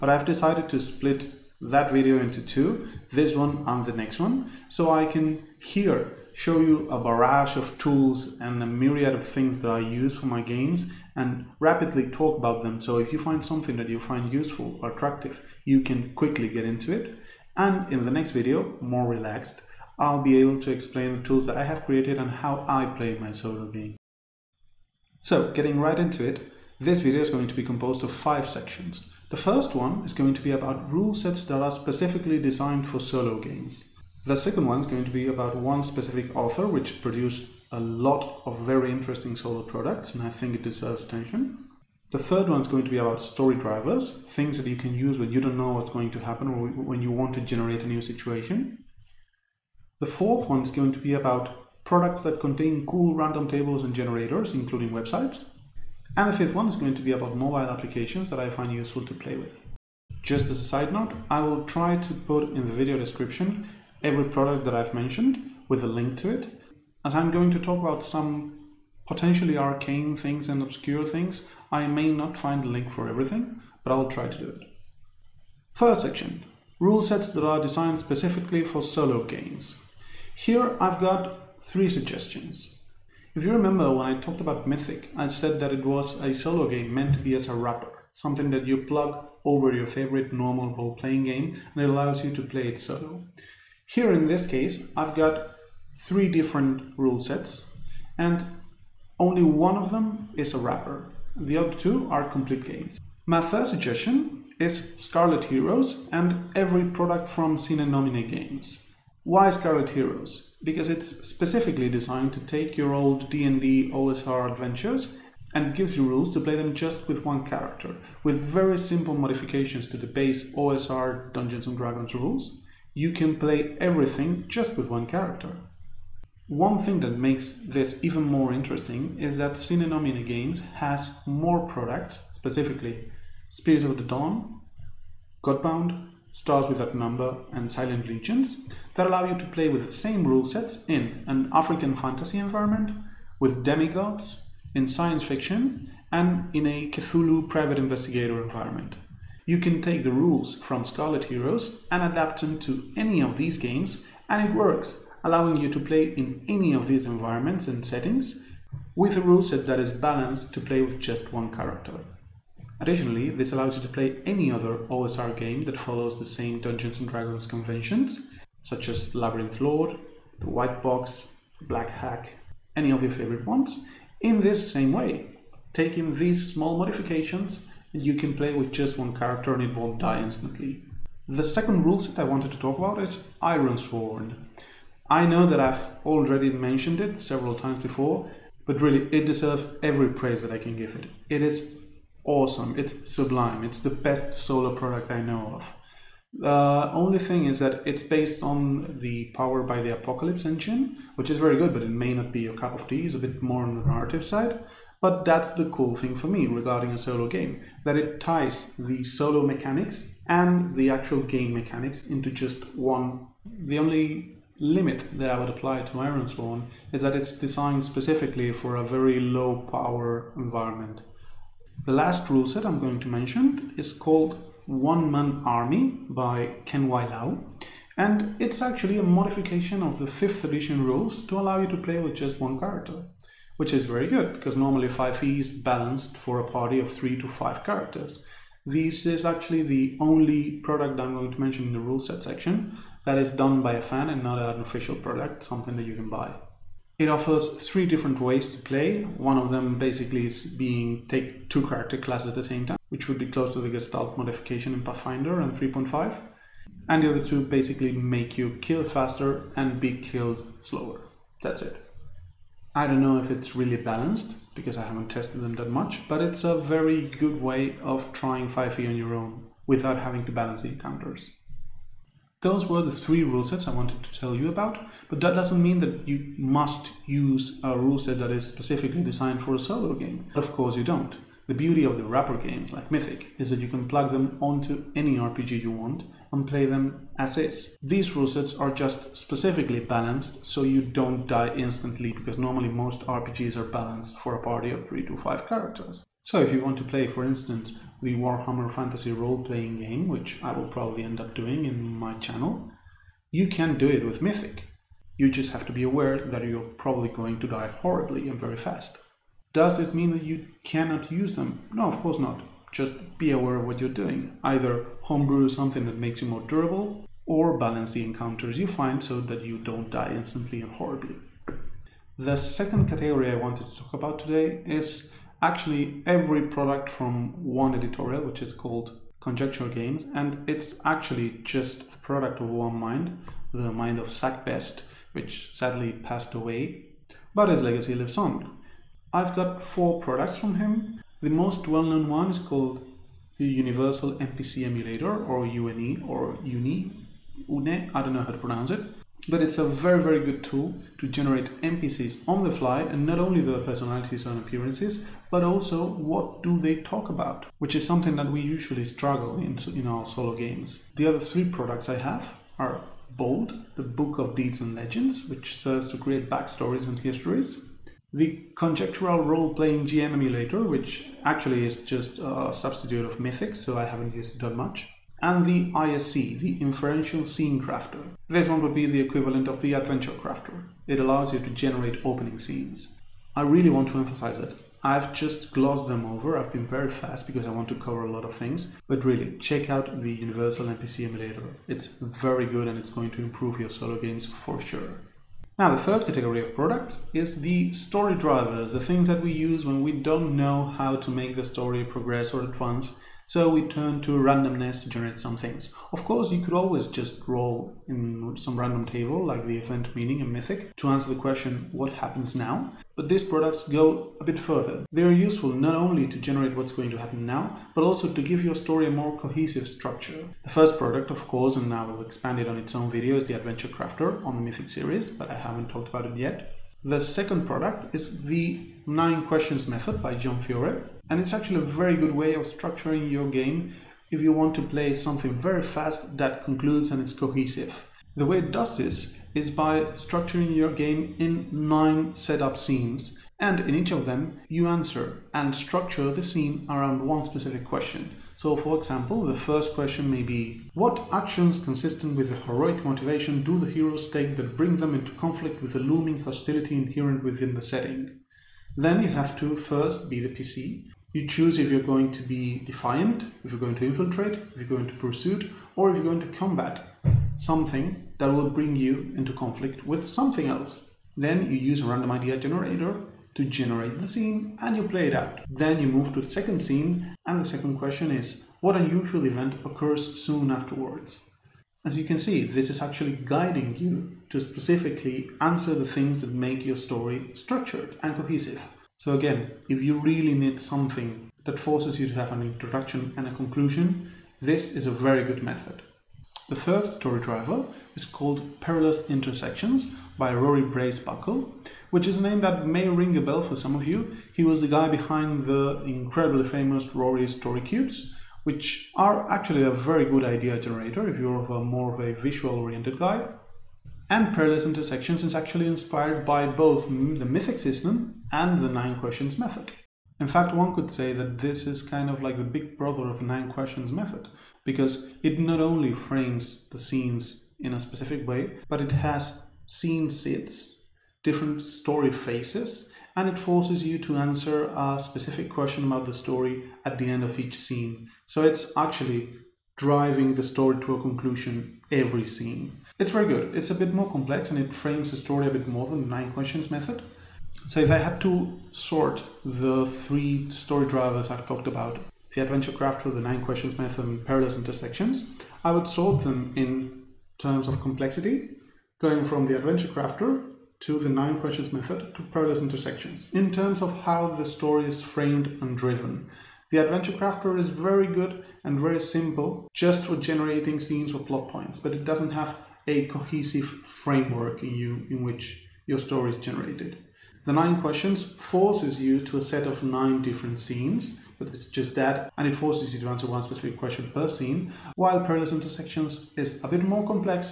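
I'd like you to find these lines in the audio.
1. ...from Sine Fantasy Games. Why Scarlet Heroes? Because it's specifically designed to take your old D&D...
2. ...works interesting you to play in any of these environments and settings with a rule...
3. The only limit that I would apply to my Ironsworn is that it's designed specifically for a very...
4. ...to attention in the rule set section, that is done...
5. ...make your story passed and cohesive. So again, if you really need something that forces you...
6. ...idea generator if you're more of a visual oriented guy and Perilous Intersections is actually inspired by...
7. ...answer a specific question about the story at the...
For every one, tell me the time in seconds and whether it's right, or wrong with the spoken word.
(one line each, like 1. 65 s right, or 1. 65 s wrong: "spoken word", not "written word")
1. 107 s wrong: "Nomine", not "Fantasy"
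2. 154 s wrong: "allowing", not "interesting"
3. 213 s right
4. 241 s wrong: "mention", not "attention"
5. 486 s wrong: "structured", not "passed"
6. 510 s right
7. 534 s right.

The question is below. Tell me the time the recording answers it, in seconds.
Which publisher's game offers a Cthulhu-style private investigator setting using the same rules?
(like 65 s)
137 s.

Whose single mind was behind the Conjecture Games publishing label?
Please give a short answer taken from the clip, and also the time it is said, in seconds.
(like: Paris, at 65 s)
Zach Best, at 334 s.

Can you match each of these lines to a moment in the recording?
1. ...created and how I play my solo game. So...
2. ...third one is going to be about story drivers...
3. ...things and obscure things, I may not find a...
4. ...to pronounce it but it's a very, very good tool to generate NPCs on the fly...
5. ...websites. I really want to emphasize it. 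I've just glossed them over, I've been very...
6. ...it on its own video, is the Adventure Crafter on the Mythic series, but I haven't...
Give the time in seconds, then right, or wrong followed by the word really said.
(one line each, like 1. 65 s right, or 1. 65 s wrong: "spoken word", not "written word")
1. 21 s right
2. 42 s right
3. 70 s right
4. 348 s right
5. 382 s wrong: "scenes", not "websites"
6. 422 s right.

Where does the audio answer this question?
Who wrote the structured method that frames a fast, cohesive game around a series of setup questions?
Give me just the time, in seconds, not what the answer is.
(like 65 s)
430 s.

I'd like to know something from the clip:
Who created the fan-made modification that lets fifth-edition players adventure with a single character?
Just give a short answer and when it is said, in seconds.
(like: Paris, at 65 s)
Ken Wai, at 226 s.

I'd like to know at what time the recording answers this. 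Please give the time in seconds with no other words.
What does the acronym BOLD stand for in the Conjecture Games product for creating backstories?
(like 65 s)
363 s.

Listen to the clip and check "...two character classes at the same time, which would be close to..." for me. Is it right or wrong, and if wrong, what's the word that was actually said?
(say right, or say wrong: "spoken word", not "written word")
right.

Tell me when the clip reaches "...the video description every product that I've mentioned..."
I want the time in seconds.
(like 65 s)
62 s.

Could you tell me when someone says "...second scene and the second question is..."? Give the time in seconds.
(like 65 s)
476 s.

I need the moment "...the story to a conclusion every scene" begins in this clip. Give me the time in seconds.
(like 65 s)
540 s.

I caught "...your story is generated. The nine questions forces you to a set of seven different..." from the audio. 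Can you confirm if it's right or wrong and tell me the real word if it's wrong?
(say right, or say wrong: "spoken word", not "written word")
wrong: "nine", not "seven".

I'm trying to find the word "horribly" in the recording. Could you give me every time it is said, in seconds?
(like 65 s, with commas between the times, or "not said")
307 s, 320 s.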